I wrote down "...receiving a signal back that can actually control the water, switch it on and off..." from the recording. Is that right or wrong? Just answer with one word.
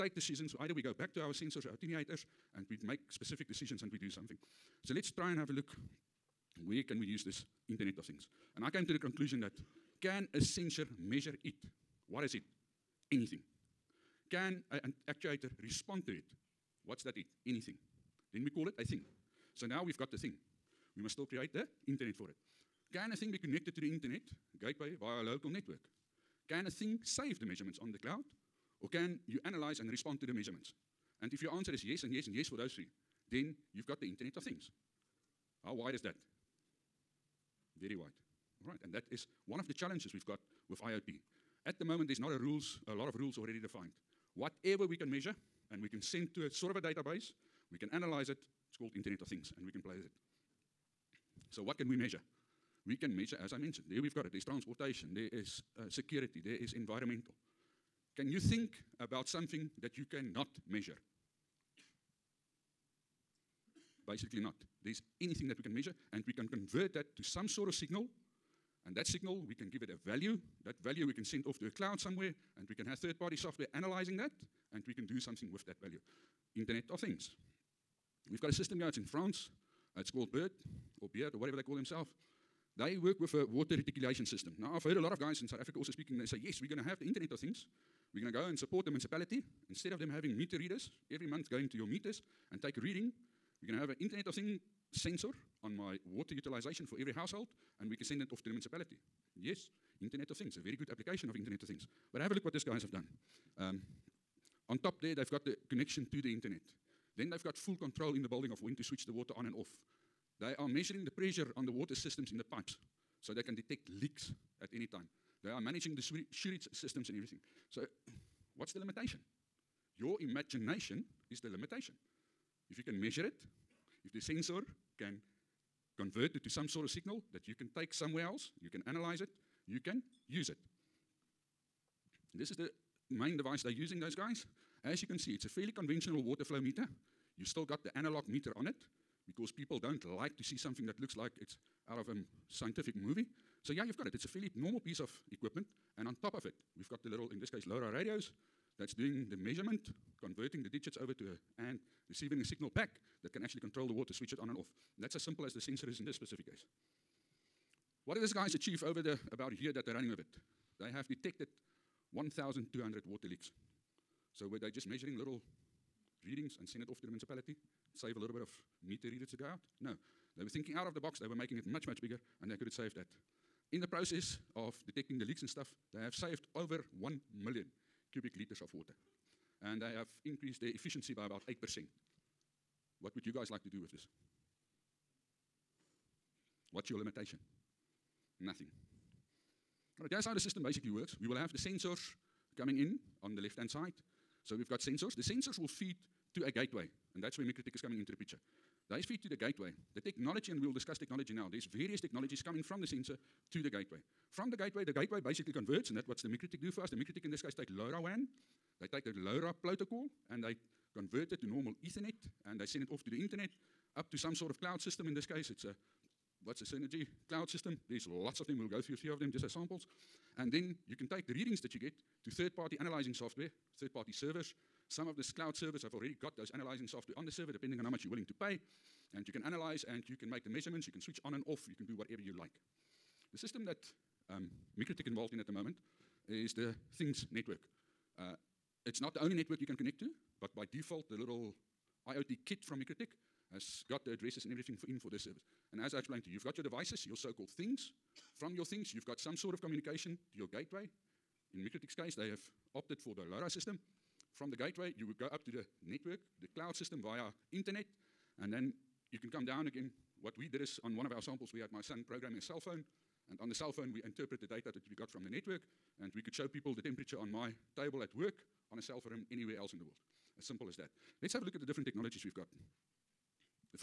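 right.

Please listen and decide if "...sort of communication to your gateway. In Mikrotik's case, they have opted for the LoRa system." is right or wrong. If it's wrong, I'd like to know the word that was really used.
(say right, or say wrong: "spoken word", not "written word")
right.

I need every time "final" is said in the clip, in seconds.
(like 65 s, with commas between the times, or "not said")
not said.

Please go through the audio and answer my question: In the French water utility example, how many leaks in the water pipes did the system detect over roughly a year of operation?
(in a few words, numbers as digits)
1,200.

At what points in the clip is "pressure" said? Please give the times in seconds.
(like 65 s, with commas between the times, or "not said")
111 s.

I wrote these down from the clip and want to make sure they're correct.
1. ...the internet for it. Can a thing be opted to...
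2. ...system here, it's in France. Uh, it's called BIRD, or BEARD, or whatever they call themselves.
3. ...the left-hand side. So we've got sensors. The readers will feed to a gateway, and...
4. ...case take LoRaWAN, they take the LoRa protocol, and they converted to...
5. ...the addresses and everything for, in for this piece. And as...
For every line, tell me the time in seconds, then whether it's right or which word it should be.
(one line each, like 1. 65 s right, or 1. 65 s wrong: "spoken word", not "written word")
1. 21 s wrong: "connected", not "opted"
2. 78 s right
3. 193 s wrong: "sensors", not "readers"
4. 207 s right
5. 244 s wrong: "service", not "piece".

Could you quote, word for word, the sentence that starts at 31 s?
And if your answer is yes and yes and yes for those three, then you've got the Internet of Things.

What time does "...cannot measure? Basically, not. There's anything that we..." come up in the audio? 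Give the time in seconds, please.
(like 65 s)
60 s.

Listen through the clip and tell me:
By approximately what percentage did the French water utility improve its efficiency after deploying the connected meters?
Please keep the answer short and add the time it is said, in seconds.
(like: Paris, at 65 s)
8%, at 181 s.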